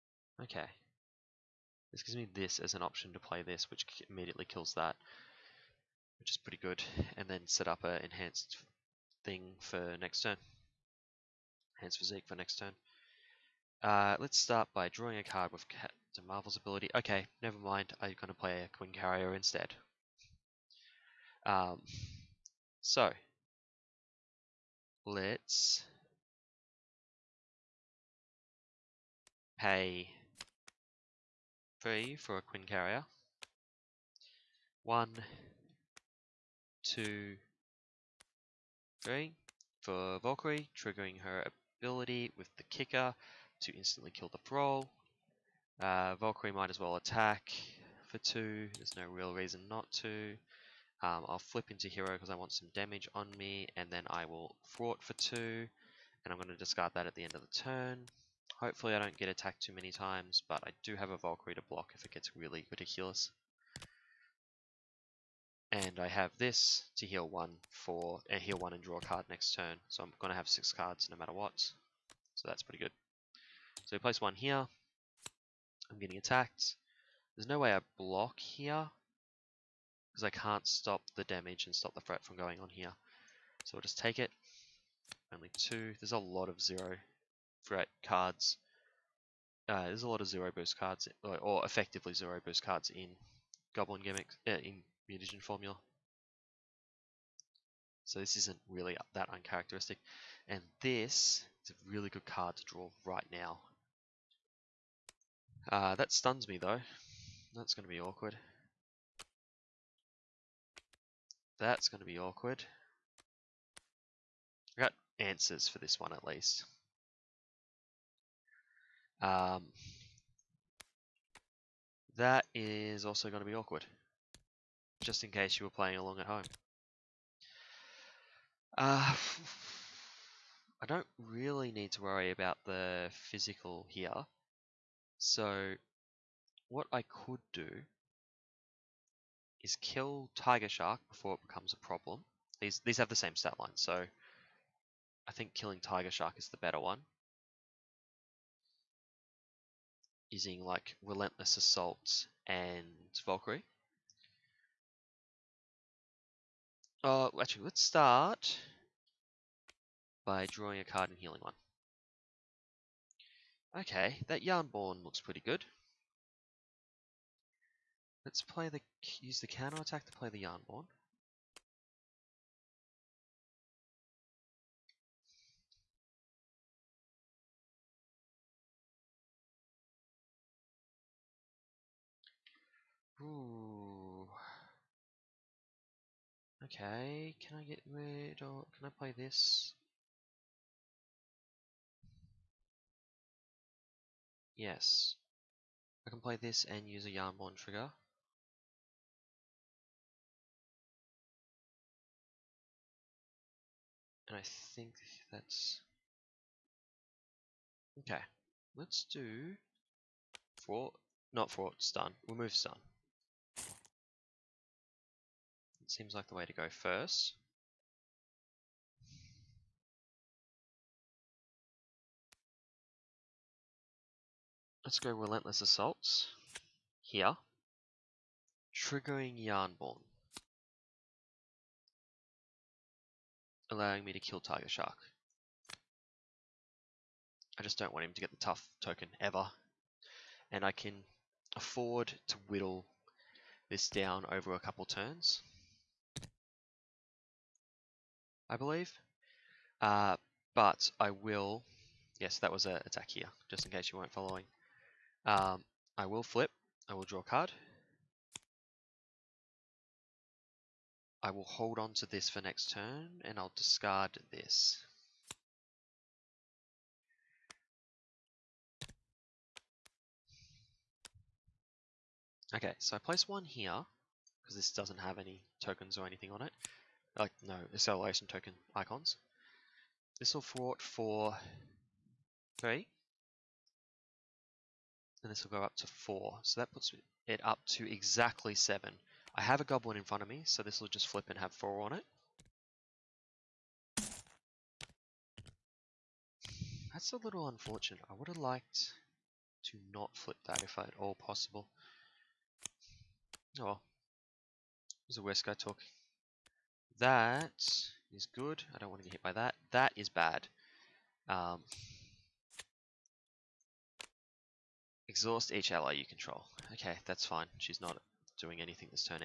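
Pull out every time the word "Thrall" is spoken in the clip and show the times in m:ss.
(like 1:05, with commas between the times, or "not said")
0:44.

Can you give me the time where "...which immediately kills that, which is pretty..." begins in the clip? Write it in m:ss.
0:03.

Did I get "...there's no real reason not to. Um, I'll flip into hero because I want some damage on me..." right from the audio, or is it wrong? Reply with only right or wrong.
right.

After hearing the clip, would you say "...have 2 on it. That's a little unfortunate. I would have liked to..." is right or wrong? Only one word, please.
wrong.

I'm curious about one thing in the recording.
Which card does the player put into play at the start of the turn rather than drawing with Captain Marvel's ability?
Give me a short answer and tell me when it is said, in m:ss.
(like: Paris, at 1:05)
Quinncarrier, at 0:18.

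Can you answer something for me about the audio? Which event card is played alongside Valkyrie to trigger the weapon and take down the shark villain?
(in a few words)
Relentless Assault.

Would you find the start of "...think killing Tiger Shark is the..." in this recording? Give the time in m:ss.
2:25.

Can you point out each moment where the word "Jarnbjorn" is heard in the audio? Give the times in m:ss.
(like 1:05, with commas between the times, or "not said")
2:44, 2:50, 3:17, 3:49.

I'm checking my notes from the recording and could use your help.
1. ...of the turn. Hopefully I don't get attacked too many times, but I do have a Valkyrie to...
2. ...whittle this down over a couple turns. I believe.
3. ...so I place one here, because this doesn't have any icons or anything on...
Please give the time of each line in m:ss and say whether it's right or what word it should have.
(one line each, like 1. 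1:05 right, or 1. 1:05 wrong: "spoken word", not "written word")
1. 0:57 right
2. 4:02 right
3. 4:32 wrong: "tokens", not "icons".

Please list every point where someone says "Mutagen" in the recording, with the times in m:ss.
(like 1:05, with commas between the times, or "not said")
1:35.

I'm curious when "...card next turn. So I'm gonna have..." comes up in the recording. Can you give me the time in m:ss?
1:09.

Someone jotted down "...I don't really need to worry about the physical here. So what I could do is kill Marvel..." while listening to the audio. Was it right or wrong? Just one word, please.
wrong.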